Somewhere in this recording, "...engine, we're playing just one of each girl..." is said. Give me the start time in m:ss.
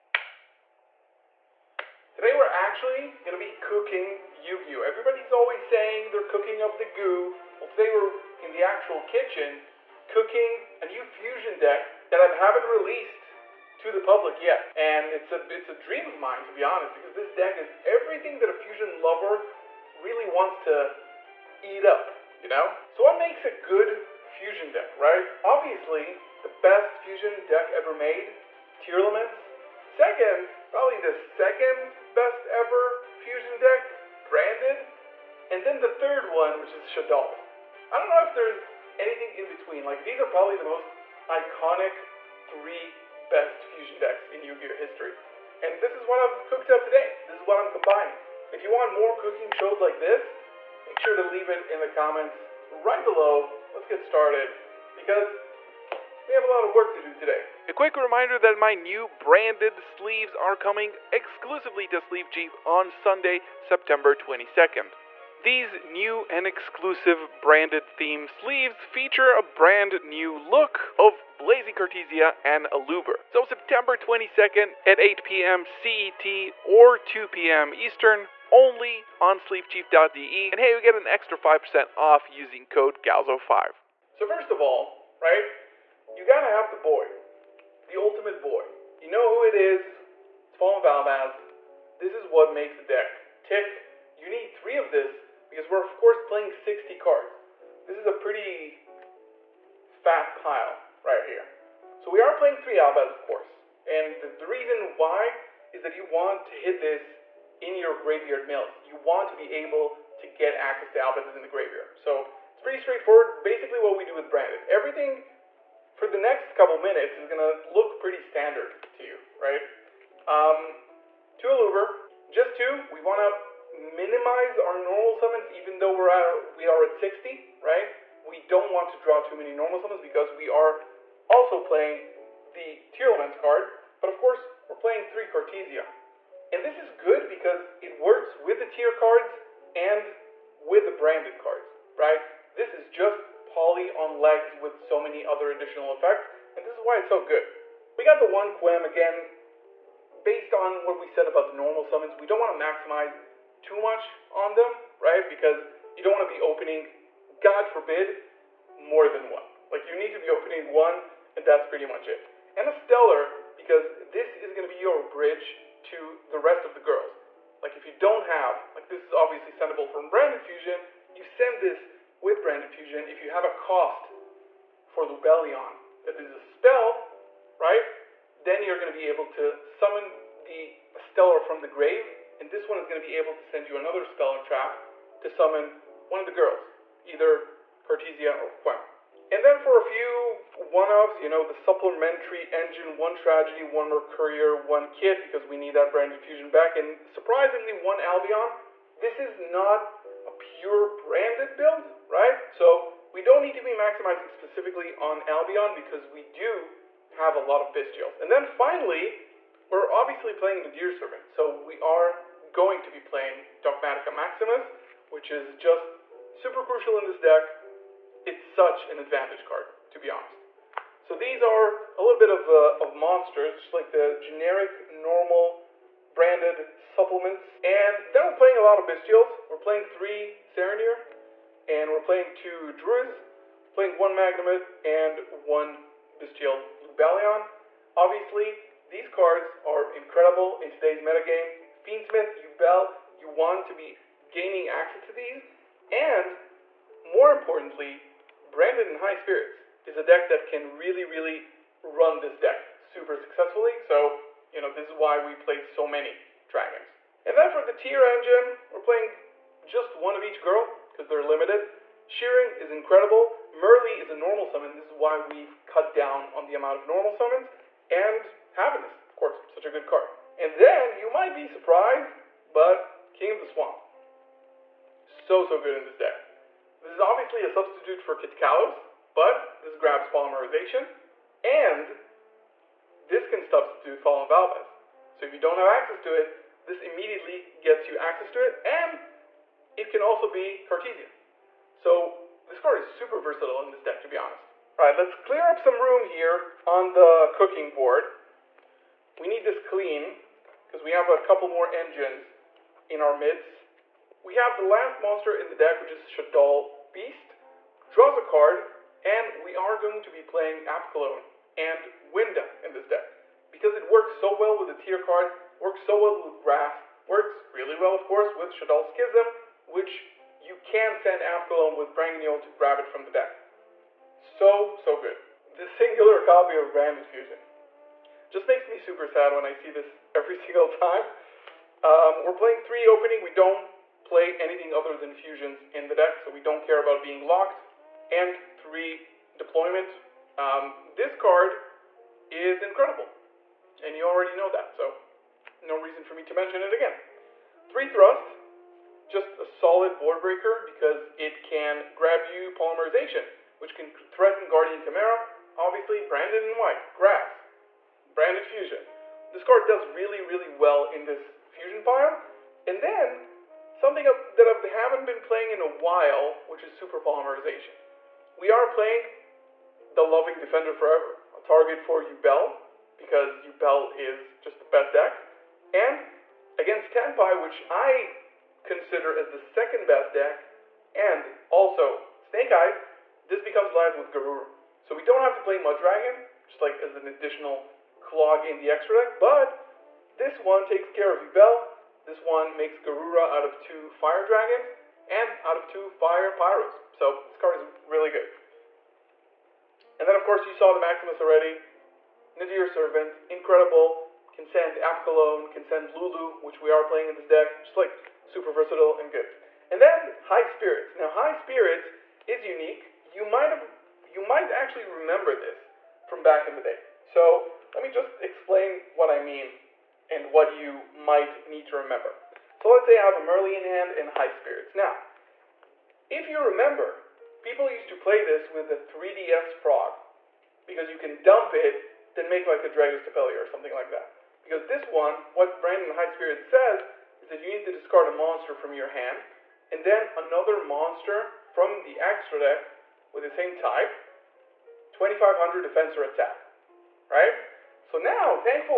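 4:18.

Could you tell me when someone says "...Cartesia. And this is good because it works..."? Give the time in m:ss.
2:15.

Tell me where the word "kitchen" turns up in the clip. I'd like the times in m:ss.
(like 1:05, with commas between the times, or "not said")
0:09.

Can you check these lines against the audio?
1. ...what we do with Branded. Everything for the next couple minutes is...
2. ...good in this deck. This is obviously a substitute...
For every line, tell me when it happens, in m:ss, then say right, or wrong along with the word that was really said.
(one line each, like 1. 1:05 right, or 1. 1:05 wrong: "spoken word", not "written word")
1. 1:53 right
2. 4:35 right.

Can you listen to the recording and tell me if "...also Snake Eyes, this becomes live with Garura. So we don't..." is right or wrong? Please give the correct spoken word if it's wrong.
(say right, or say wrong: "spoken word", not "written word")
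right.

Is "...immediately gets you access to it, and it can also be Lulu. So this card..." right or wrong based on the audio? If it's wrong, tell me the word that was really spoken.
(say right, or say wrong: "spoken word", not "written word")
wrong: "Cartesia", not "Lulu".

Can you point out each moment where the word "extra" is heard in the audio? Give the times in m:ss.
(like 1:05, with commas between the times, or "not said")
1:21, 6:28, 7:22.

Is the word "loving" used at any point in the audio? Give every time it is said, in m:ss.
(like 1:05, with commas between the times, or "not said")
6:10.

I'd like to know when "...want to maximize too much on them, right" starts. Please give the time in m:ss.
2:32.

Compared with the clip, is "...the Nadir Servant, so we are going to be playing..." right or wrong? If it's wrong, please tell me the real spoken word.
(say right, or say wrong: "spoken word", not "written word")
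right.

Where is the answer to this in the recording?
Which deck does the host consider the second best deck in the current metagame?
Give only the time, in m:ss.
6:16.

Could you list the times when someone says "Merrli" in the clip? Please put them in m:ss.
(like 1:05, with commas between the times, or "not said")
4:23, 7:03.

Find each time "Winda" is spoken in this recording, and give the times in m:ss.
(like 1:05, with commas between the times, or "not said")
5:12.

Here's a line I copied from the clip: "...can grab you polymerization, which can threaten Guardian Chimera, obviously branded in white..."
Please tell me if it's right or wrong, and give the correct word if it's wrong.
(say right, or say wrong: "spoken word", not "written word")
right.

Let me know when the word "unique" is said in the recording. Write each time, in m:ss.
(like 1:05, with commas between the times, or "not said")
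6:52.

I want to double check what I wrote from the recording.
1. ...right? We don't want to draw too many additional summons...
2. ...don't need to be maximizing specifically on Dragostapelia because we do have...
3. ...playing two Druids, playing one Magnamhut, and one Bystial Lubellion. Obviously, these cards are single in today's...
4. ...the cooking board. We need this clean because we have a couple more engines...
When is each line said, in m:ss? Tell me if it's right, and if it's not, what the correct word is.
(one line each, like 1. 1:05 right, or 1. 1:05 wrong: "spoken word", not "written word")
1. 2:07 wrong: "normal", not "additional"
2. 3:23 wrong: "Albion", not "Dragostapelia"
3. 3:52 wrong: "incredible", not "single"
4. 4:56 right.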